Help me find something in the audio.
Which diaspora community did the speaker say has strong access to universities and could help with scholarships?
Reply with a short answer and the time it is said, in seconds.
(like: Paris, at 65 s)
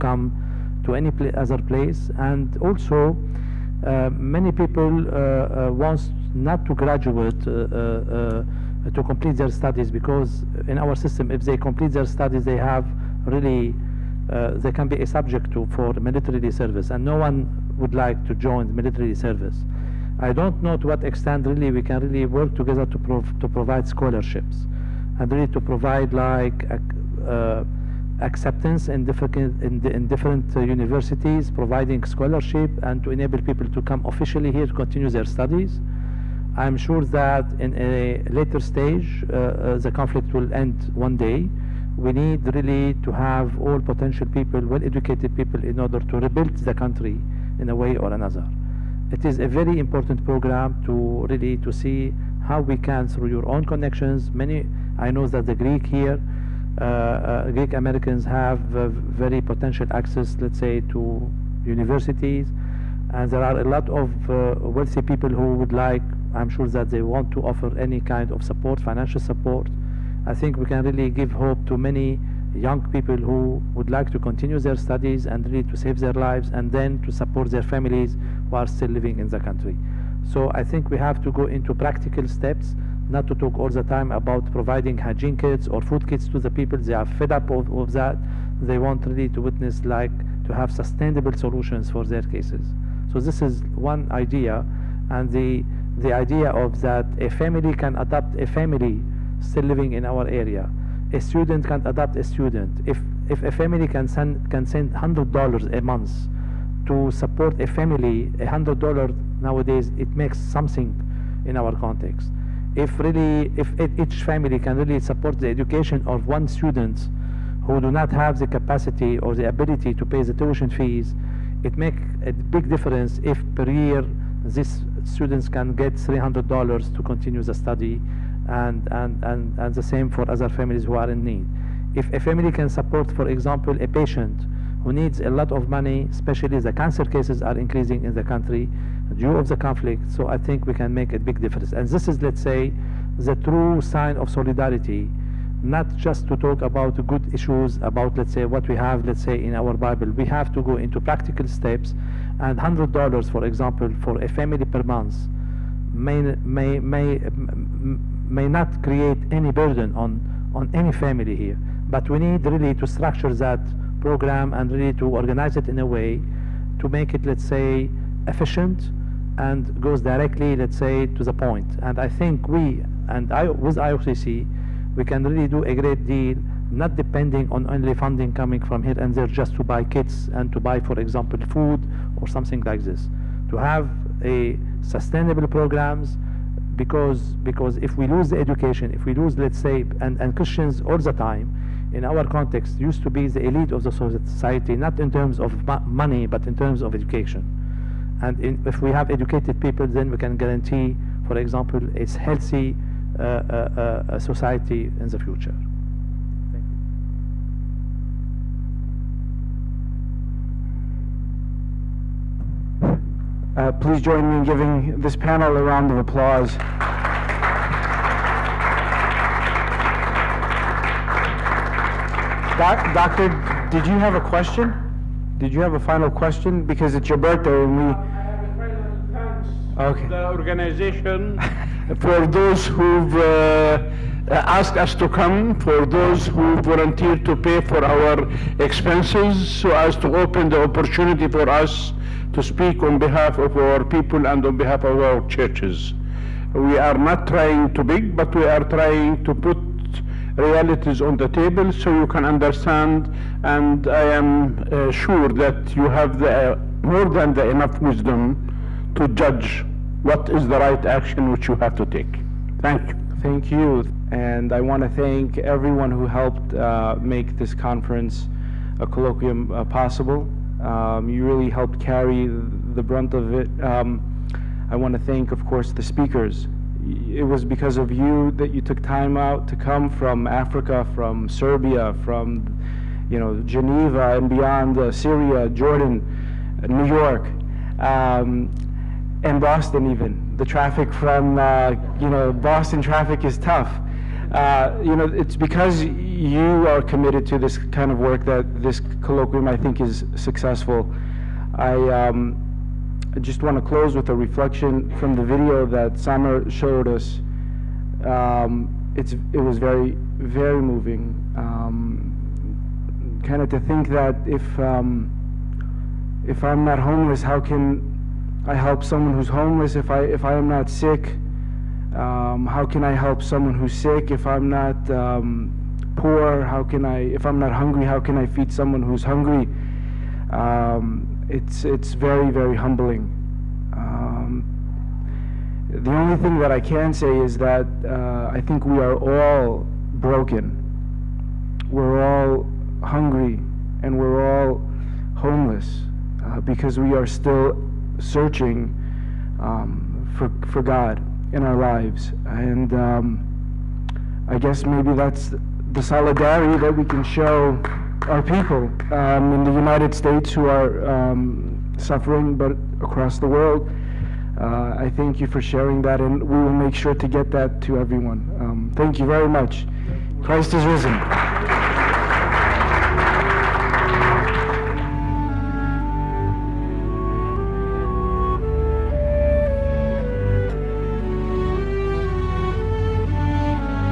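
Greek Americans, at 57 s.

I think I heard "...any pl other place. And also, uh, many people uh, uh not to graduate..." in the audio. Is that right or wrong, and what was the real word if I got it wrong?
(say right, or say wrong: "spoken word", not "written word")
right.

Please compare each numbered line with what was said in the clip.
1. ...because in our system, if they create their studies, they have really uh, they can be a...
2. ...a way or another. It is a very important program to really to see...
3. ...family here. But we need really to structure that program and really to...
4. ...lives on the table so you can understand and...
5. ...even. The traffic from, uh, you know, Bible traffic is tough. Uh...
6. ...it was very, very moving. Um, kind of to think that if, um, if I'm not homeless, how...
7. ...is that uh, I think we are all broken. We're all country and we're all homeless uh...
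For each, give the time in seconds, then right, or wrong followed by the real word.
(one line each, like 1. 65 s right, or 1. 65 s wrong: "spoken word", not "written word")
1. 9 s wrong: "complete", not "create"
2. 47 s right
3. 160 s right
4. 250 s wrong: "realities", not "lives"
5. 289 s wrong: "Boston", not "Bible"
6. 309 s right
7. 337 s wrong: "hungry", not "country".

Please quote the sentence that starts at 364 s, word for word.
Uh, I thank you for sharing that, and we will make sure to get that to everyone.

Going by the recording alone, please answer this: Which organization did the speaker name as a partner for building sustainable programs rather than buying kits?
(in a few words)
IOCC.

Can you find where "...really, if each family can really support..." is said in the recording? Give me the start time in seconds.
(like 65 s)
112 s.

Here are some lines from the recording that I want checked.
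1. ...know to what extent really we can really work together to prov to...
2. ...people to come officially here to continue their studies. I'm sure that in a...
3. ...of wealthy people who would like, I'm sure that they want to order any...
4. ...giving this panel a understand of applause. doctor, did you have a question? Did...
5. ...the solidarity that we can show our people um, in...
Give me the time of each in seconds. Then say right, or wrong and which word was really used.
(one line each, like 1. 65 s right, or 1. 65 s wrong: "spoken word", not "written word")
1. 20 s right
2. 33 s right
3. 63 s wrong: "offer", not "order"
4. 214 s wrong: "round", not "understand"
5. 355 s right.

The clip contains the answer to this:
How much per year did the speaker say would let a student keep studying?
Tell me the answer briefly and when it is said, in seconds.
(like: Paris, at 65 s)
$300, at 125 s.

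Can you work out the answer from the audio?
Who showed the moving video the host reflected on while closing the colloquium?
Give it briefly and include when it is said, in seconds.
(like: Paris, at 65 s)
Summer, at 305 s.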